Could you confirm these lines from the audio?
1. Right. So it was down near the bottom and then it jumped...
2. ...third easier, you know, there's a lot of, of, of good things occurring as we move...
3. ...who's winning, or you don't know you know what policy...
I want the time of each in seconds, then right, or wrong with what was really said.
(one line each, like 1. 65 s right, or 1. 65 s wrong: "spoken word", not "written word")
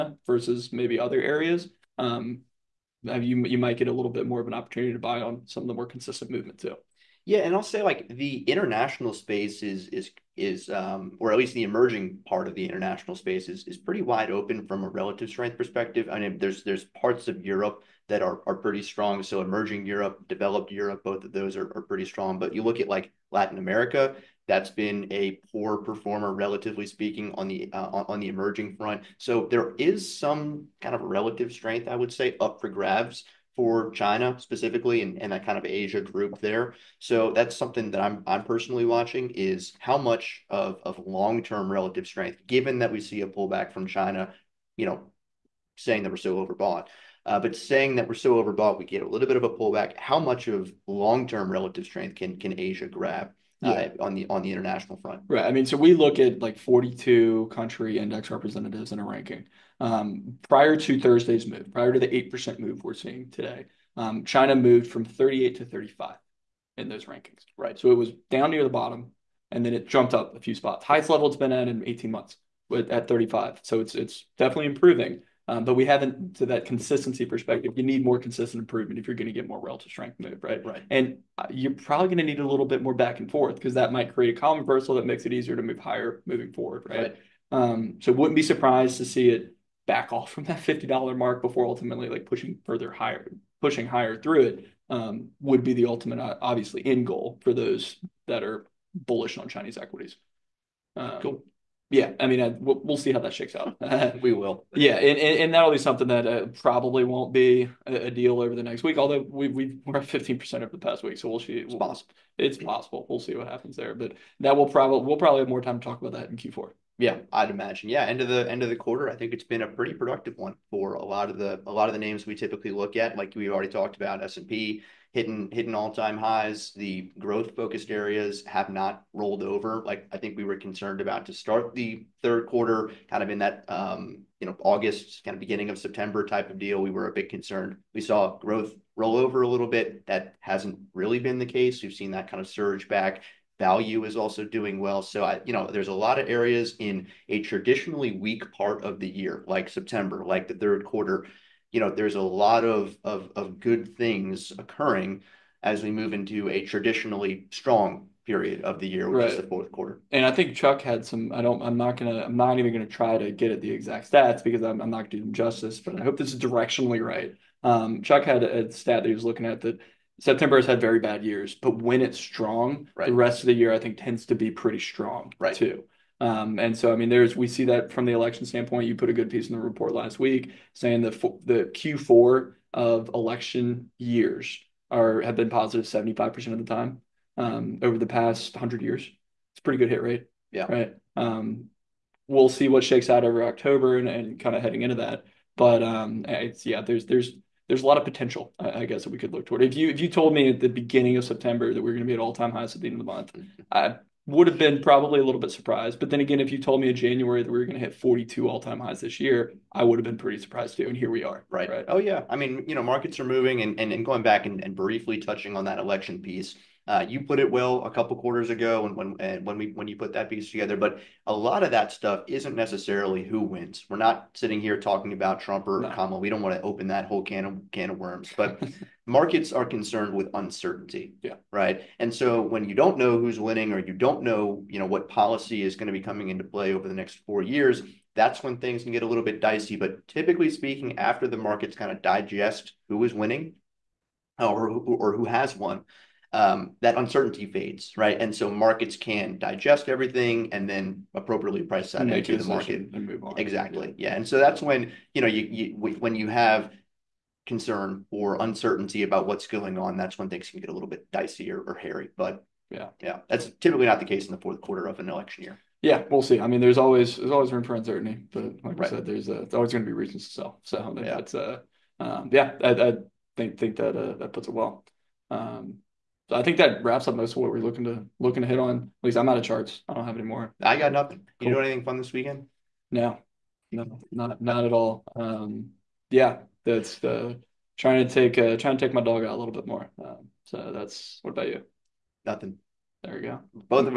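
1. 67 s right
2. 150 s wrong: "quarter", not "easier"
3. 233 s right.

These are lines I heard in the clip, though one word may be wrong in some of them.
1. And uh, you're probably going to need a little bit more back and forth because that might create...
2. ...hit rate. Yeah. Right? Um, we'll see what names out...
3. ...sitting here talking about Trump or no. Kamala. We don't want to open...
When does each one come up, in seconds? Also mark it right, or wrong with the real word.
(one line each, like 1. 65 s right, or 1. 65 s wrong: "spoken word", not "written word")
1. 80 s right
2. 189 s wrong: "shakes", not "names"
3. 224 s right.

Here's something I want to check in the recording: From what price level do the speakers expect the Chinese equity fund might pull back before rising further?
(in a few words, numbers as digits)
$50.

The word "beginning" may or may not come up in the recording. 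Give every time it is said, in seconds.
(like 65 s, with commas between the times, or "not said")
135 s, 200 s.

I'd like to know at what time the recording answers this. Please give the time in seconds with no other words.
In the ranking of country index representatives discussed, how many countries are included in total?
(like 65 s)
56 s.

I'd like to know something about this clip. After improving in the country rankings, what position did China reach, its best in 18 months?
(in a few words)
35.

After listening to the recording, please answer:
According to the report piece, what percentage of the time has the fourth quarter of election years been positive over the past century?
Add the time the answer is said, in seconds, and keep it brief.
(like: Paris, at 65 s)
75%, at 185 s.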